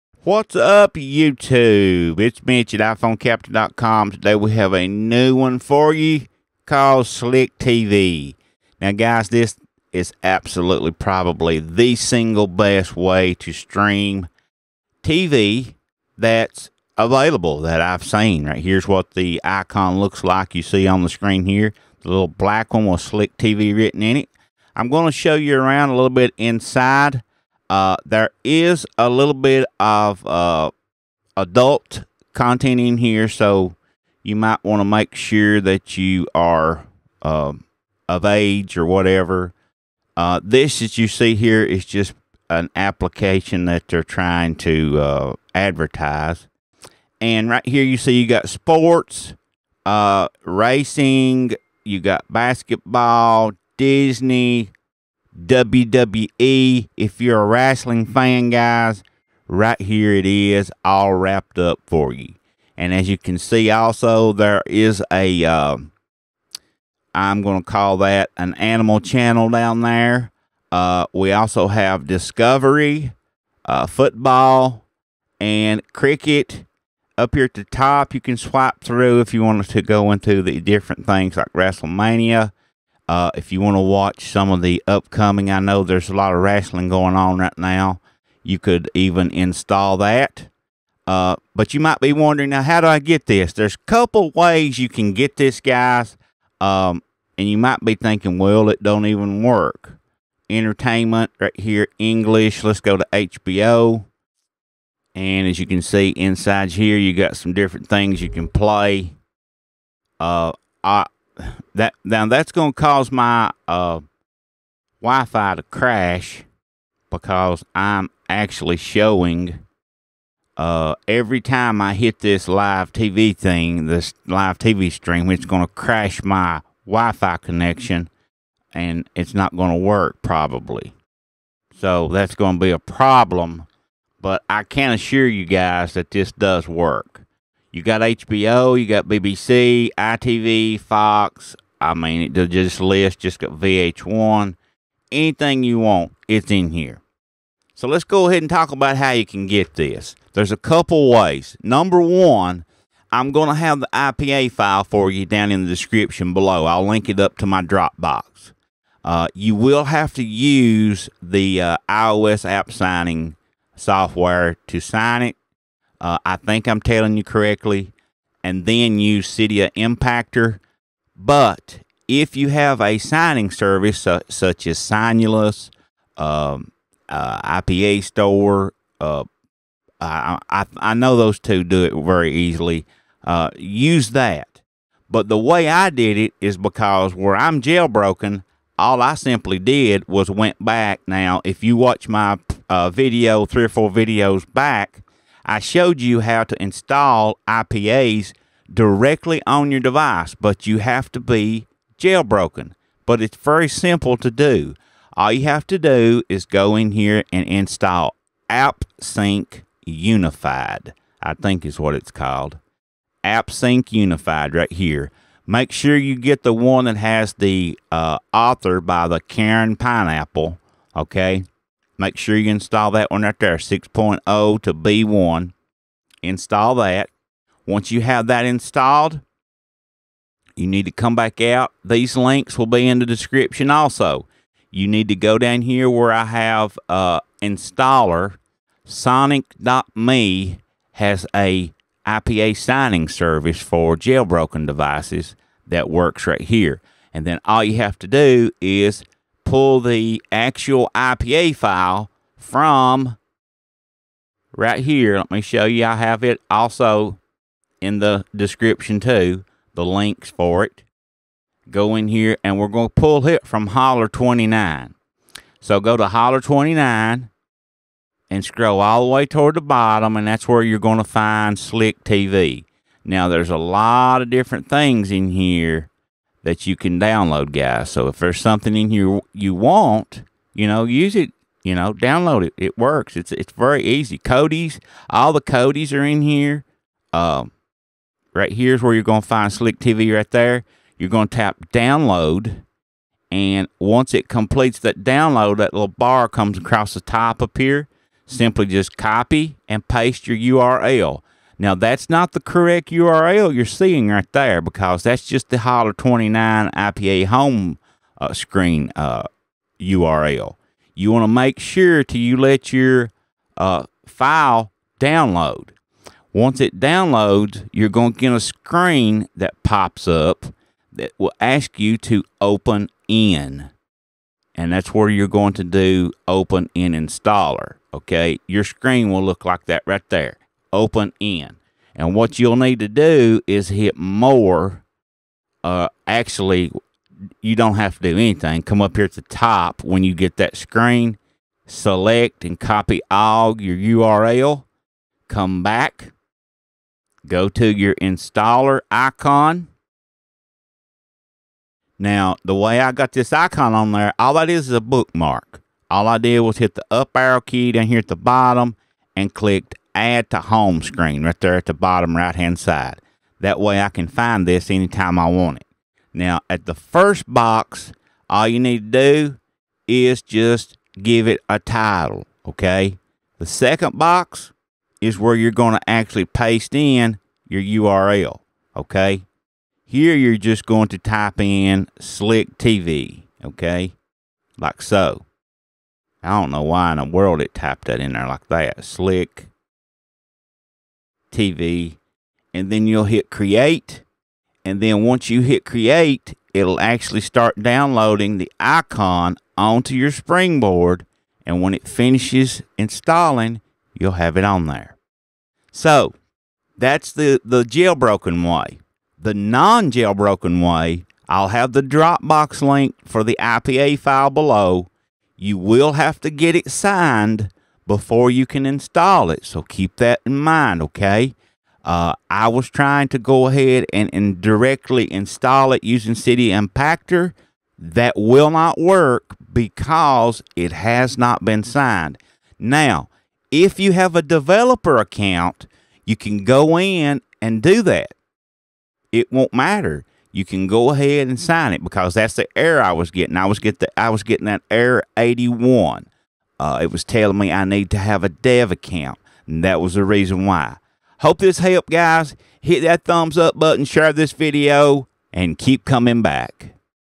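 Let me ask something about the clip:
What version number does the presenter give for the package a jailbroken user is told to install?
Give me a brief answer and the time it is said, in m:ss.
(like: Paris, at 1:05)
6.0 to B1, at 3:43.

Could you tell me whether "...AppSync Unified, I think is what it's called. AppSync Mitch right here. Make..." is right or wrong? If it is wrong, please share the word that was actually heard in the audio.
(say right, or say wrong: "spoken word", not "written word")
wrong: "Unified", not "Mitch".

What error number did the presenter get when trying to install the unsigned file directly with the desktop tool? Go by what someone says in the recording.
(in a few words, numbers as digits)
81.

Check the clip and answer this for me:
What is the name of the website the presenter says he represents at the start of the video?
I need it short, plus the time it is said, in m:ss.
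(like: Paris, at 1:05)
iPhoneCaptain.com, at 0:02.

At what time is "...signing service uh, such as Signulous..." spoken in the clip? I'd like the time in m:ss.
2:52.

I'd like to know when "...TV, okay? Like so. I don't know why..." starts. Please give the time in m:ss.
6:22.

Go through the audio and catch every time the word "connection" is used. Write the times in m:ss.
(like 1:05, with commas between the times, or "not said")
2:07.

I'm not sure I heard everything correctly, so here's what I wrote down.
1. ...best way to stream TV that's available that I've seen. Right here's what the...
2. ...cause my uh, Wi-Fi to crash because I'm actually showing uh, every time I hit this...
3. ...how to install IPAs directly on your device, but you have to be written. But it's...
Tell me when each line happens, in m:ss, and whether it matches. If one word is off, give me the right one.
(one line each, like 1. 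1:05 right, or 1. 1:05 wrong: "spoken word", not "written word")
1. 0:12 right
2. 1:52 right
3. 3:16 wrong: "jailbroken", not "written".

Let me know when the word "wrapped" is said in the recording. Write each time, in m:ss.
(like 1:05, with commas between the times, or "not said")
1:01.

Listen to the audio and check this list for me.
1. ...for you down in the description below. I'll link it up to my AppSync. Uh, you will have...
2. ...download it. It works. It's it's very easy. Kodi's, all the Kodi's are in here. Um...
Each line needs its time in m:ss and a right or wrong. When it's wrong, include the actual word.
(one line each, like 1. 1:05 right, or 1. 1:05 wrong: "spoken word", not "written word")
1. 2:34 wrong: "Dropbox", not "AppSync"
2. 4:41 right.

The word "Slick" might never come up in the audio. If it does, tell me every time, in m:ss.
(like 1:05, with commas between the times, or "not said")
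0:07, 0:23, 4:31, 4:49, 6:21, 6:28.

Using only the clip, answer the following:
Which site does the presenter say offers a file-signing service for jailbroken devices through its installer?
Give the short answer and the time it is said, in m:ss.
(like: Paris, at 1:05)
Sonic.me, at 3:58.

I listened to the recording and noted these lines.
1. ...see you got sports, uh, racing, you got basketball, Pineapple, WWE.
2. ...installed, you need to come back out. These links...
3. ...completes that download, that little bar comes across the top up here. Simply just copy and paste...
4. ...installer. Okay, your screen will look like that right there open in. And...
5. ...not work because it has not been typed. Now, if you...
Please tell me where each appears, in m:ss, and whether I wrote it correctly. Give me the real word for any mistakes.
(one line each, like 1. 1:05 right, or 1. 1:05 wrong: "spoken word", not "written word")
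1. 0:47 wrong: "Disney", not "Pineapple"
2. 3:48 right
3. 4:54 right
4. 5:26 right
5. 7:08 wrong: "signed", not "typed".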